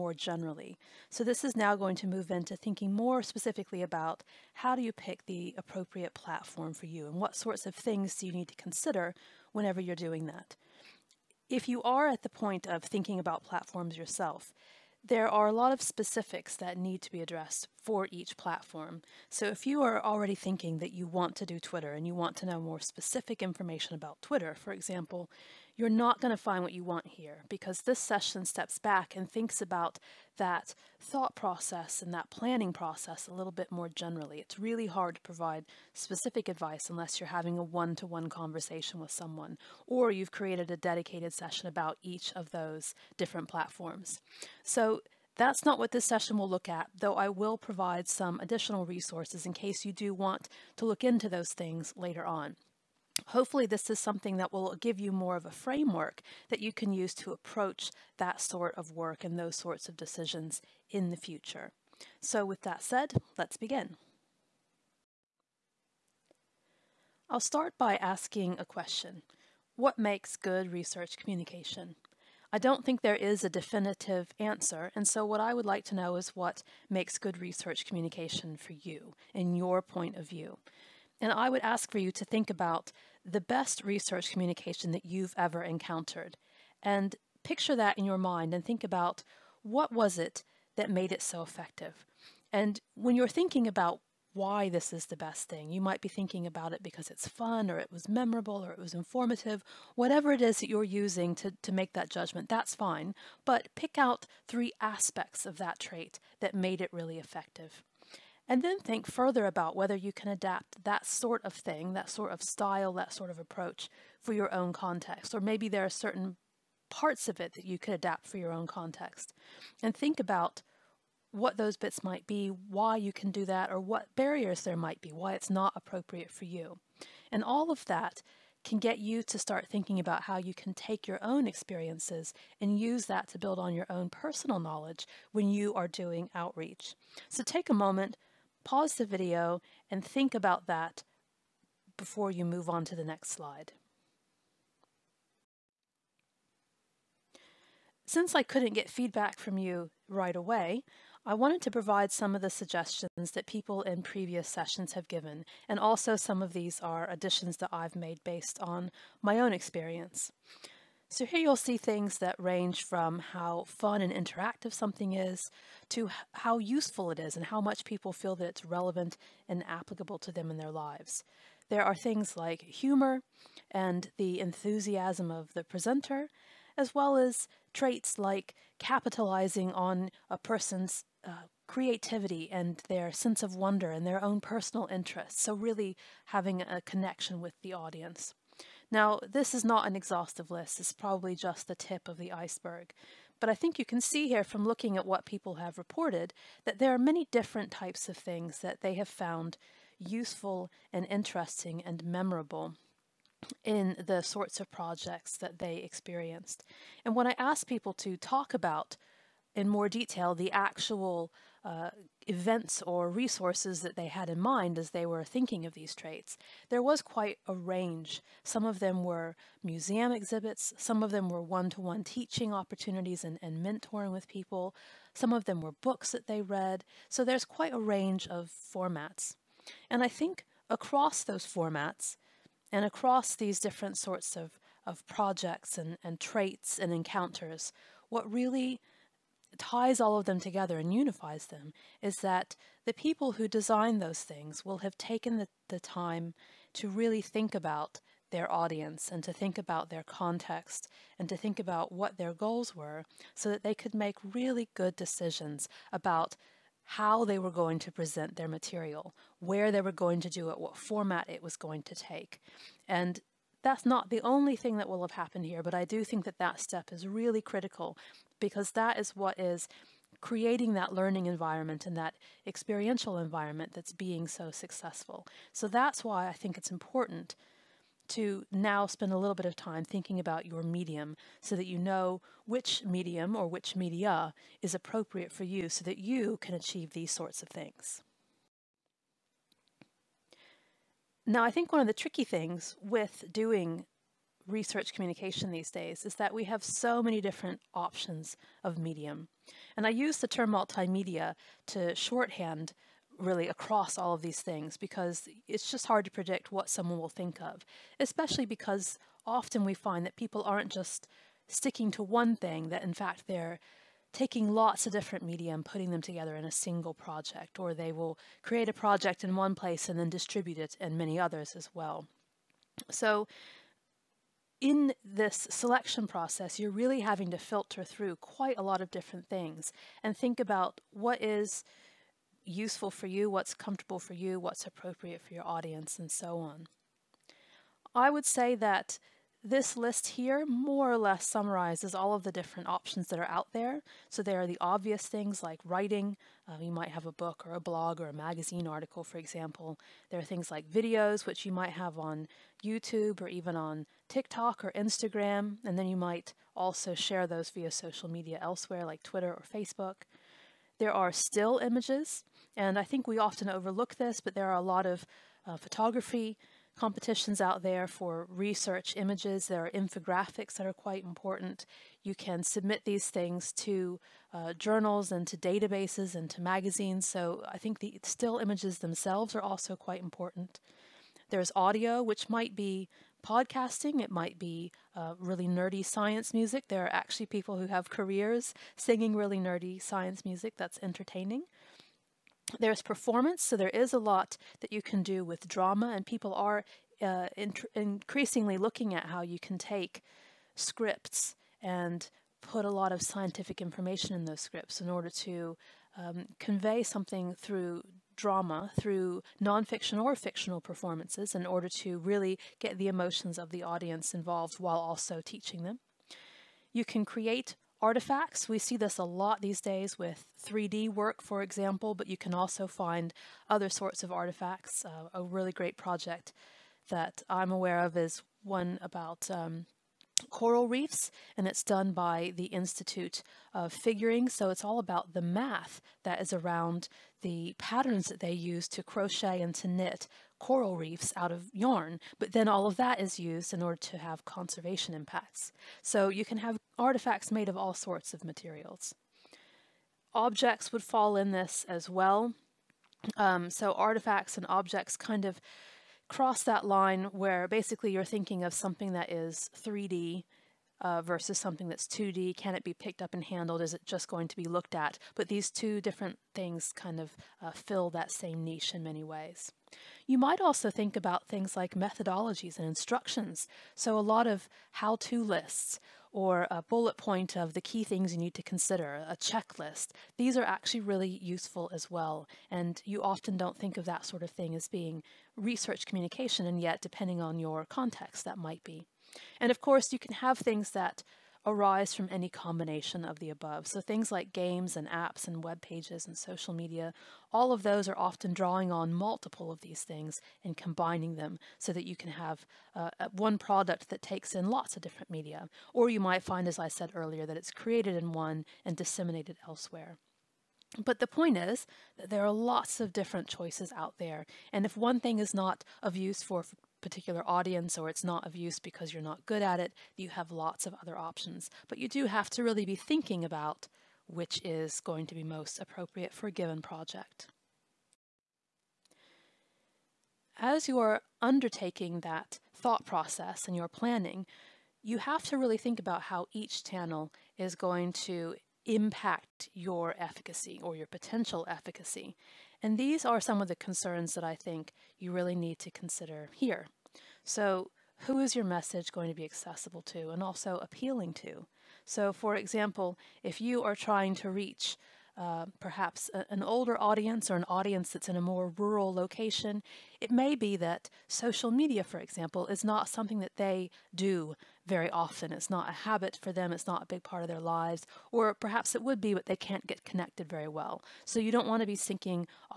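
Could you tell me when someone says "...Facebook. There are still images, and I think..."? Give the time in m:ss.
5:59.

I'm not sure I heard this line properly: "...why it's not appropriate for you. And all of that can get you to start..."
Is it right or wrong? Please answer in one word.
right.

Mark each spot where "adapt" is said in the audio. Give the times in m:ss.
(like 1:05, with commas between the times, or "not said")
1:50, 1:57.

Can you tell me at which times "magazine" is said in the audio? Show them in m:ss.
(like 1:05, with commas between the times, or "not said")
5:48, 6:16.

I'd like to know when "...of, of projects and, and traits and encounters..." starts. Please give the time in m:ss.
3:54.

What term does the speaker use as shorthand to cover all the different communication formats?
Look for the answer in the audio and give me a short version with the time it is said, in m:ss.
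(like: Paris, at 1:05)
Multimedia, at 5:00.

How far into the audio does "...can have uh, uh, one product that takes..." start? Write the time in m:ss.
8:21.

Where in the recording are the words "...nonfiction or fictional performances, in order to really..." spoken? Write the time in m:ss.
6:49.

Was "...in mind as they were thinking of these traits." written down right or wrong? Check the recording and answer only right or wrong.
right.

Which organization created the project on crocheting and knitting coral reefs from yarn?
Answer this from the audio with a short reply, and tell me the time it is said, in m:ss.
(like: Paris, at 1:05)
Institute of Figuring, at 7:12.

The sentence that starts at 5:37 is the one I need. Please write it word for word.
I would say that this list here more or less summarizes all of the different options that are out there.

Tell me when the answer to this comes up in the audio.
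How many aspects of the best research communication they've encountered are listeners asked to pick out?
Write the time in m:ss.
1:44.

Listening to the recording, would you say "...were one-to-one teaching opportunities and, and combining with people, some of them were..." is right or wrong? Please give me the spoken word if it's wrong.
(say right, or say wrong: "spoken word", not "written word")
wrong: "mentoring", not "combining".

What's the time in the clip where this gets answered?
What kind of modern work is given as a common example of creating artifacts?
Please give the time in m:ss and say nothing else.
7:00.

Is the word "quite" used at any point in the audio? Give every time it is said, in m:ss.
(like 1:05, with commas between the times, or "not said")
3:37, 3:47, 5:28, 6:10, 6:19.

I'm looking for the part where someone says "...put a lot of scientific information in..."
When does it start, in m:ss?
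6:42.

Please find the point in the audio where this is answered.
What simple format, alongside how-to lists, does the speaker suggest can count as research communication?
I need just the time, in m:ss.
7:59.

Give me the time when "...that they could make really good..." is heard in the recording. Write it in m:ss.
4:13.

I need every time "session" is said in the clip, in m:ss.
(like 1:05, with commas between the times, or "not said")
0:27, 0:41, 0:46, 2:34.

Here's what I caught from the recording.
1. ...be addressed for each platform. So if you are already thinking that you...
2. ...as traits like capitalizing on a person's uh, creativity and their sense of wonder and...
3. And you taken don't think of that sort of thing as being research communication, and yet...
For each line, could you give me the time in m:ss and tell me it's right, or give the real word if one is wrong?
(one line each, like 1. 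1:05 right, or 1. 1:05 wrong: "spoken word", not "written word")
1. 0:17 right
2. 2:57 right
3. 8:02 wrong: "often", not "taken".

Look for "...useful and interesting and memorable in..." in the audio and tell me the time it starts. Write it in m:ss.
3:19.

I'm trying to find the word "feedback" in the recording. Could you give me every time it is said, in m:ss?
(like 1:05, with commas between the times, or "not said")
2:28.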